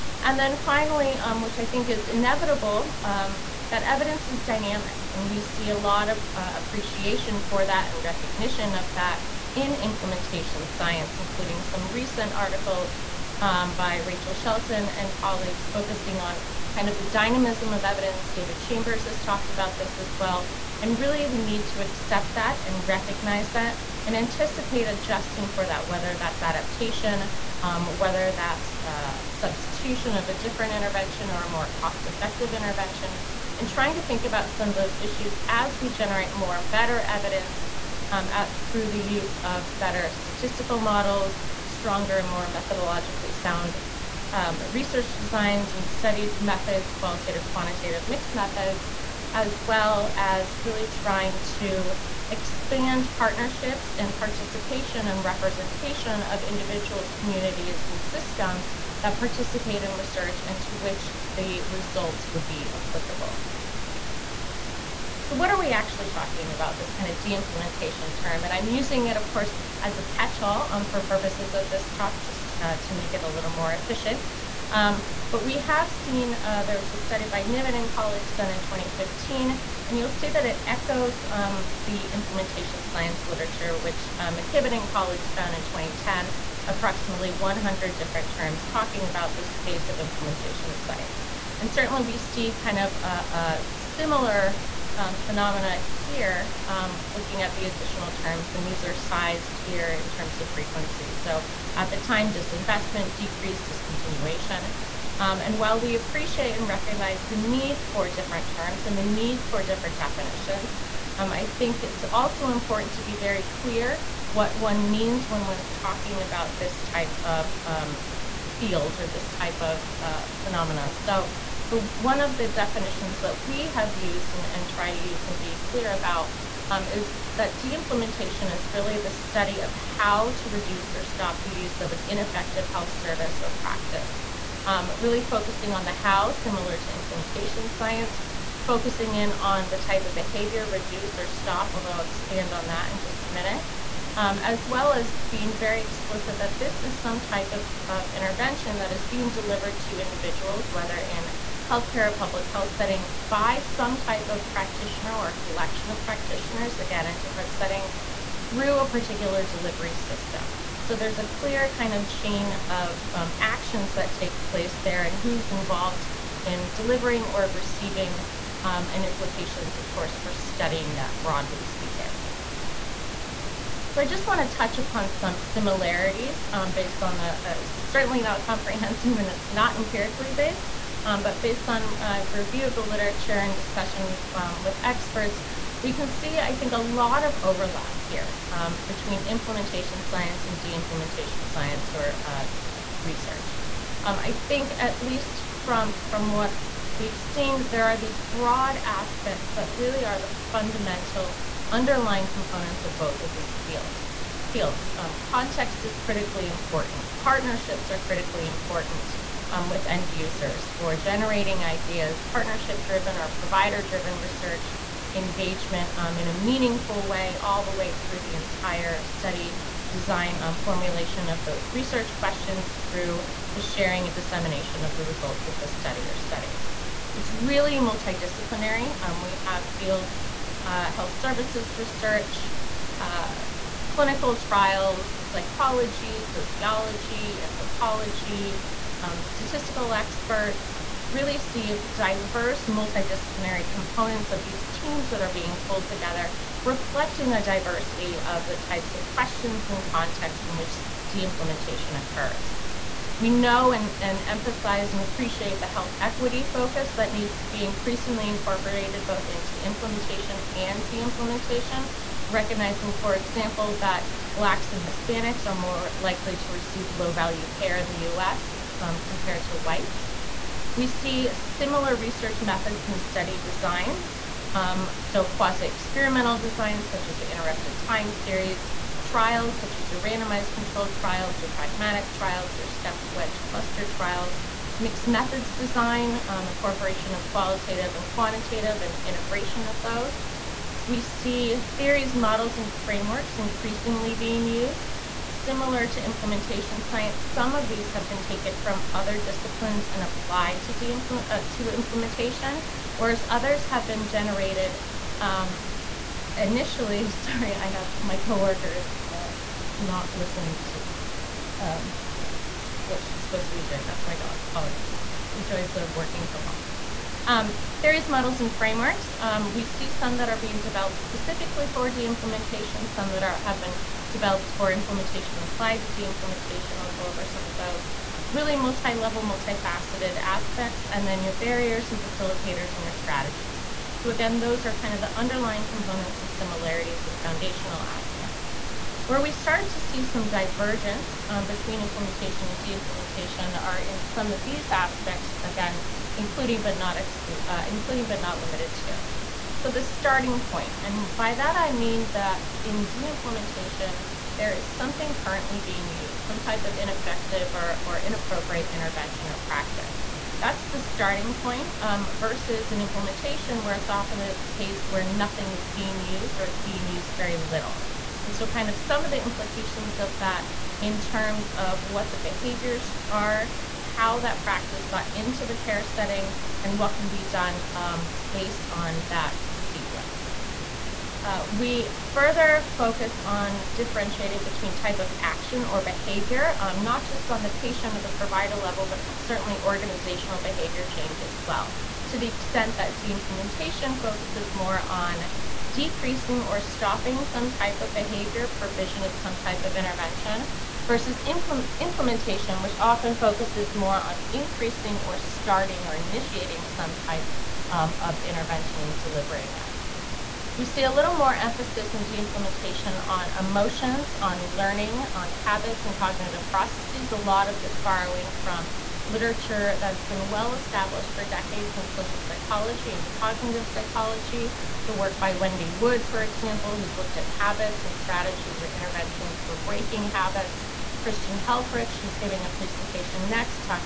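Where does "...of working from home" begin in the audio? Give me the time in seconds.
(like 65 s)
315 s.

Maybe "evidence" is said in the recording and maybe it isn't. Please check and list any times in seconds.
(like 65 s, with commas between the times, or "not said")
3 s, 17 s, 37 s.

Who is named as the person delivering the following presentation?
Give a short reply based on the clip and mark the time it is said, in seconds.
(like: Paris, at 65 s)
Christian Helfrich, at 431 s.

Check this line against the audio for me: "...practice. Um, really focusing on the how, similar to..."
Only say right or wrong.
right.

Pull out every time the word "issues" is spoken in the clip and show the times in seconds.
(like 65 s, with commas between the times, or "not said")
35 s.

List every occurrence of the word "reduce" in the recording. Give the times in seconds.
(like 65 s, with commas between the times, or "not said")
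130 s, 140 s.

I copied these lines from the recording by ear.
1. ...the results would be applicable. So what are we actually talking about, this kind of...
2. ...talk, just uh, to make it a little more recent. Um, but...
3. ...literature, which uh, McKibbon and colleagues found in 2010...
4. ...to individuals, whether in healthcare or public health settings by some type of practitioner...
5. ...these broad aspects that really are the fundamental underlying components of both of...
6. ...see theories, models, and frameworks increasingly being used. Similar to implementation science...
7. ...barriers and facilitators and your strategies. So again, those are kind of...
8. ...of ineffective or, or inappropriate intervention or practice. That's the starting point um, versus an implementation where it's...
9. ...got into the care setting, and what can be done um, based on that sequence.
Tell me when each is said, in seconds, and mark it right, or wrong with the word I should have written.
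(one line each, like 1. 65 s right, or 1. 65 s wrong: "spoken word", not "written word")
1. 61 s right
2. 71 s wrong: "efficient", not "recent"
3. 83 s right
4. 149 s right
5. 197 s right
6. 291 s right
7. 331 s right
8. 356 s right
9. 374 s right.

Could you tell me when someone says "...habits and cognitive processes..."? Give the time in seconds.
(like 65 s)
415 s.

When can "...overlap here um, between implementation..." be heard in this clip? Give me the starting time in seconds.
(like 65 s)
187 s.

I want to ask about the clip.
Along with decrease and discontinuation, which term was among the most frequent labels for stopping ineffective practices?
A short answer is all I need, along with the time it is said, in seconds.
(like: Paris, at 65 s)
Disinvestment, at 102 s.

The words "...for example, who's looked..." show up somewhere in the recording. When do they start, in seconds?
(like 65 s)
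426 s.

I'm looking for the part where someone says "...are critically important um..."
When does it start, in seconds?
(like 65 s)
207 s.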